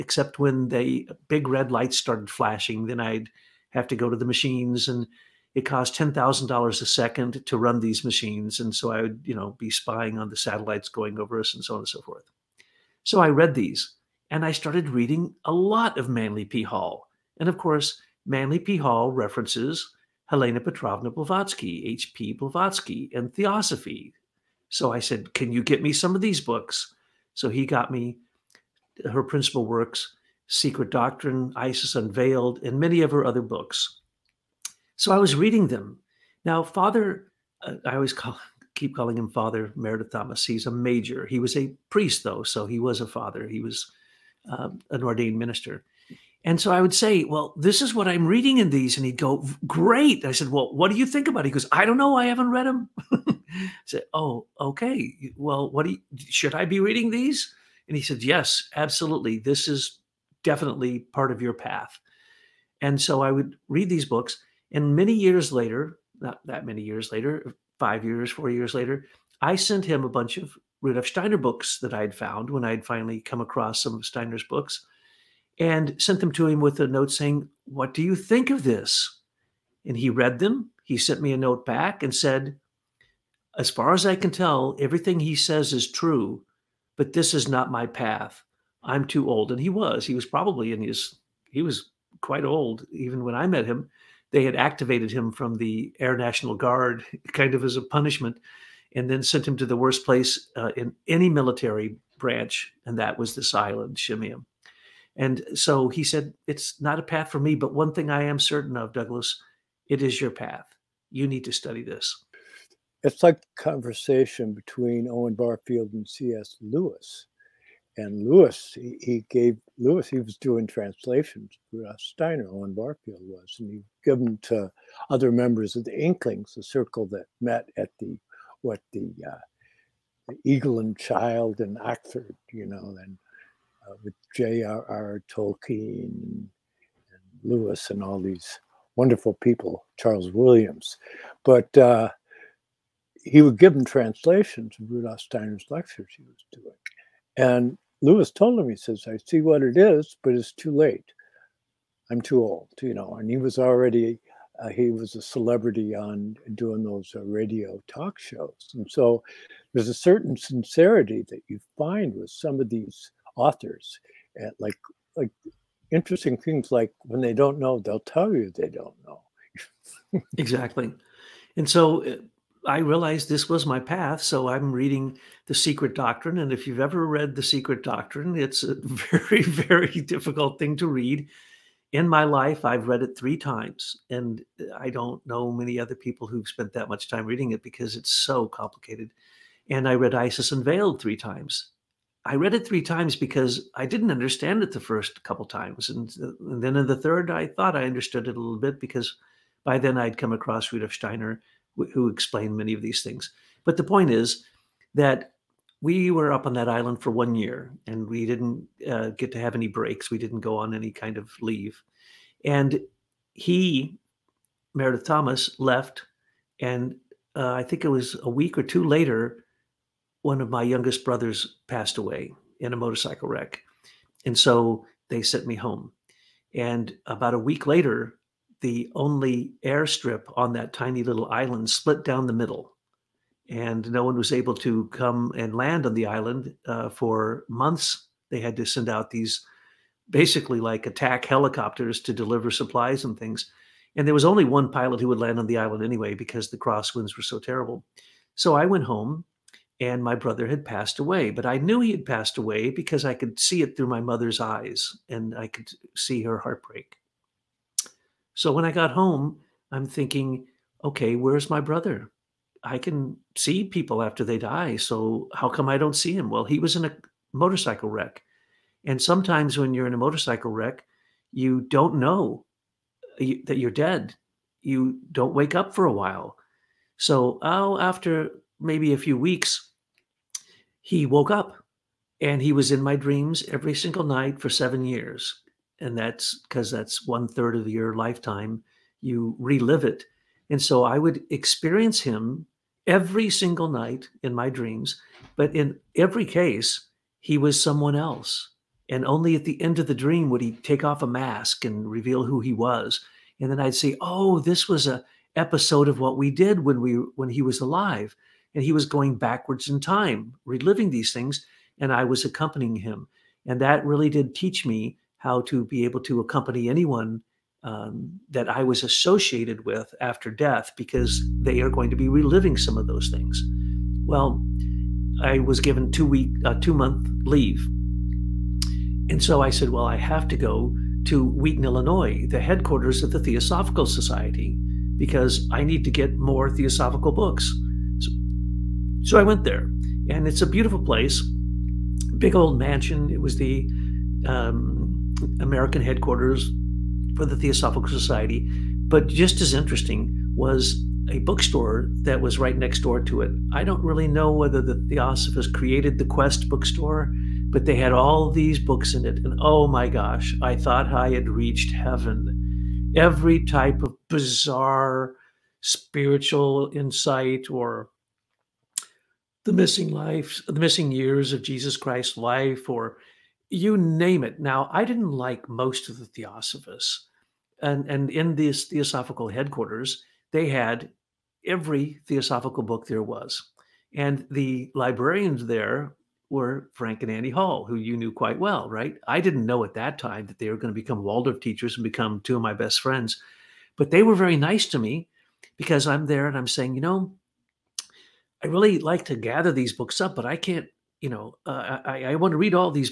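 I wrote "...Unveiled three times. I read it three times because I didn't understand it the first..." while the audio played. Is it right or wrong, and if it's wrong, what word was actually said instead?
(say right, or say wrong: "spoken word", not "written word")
right.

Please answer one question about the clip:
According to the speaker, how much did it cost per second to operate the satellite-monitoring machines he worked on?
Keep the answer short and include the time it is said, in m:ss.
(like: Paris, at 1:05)
$10,000, at 0:05.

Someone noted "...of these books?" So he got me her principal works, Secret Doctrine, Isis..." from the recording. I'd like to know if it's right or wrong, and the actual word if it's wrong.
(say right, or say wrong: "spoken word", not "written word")
right.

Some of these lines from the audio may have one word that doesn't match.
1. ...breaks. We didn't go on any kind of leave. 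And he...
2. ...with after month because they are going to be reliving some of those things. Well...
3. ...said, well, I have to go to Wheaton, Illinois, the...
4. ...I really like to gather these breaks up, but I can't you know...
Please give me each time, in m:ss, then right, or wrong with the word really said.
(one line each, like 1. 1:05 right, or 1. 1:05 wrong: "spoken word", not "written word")
1. 3:29 right
2. 5:19 wrong: "death", not "month"
3. 5:29 right
4. 6:38 wrong: "books", not "breaks".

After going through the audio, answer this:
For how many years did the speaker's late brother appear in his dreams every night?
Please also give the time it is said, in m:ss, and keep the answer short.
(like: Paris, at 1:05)
7, at 4:44.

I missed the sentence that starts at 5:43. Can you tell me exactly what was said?
It was the um, American headquarters for the Theosophical Society.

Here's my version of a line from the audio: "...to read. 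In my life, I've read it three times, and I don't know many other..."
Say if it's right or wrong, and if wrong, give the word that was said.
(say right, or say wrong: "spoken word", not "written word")
right.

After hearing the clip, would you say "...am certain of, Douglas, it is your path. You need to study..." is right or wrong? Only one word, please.
right.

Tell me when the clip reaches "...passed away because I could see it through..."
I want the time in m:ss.
4:12.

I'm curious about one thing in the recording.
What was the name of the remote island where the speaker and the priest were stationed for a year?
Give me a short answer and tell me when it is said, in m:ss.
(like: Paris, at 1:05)
Shemya, at 1:43.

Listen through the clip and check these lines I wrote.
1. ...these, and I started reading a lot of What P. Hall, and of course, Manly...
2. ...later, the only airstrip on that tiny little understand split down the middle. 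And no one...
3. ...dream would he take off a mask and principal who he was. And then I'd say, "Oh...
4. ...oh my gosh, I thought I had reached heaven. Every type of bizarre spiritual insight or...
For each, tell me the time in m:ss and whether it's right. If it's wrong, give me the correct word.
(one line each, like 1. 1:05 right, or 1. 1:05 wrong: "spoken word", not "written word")
1. 0:13 wrong: "Manly", not "What"
2. 3:47 wrong: "island", not "understand"
3. 4:59 wrong: "reveal", not "principal"
4. 5:59 right.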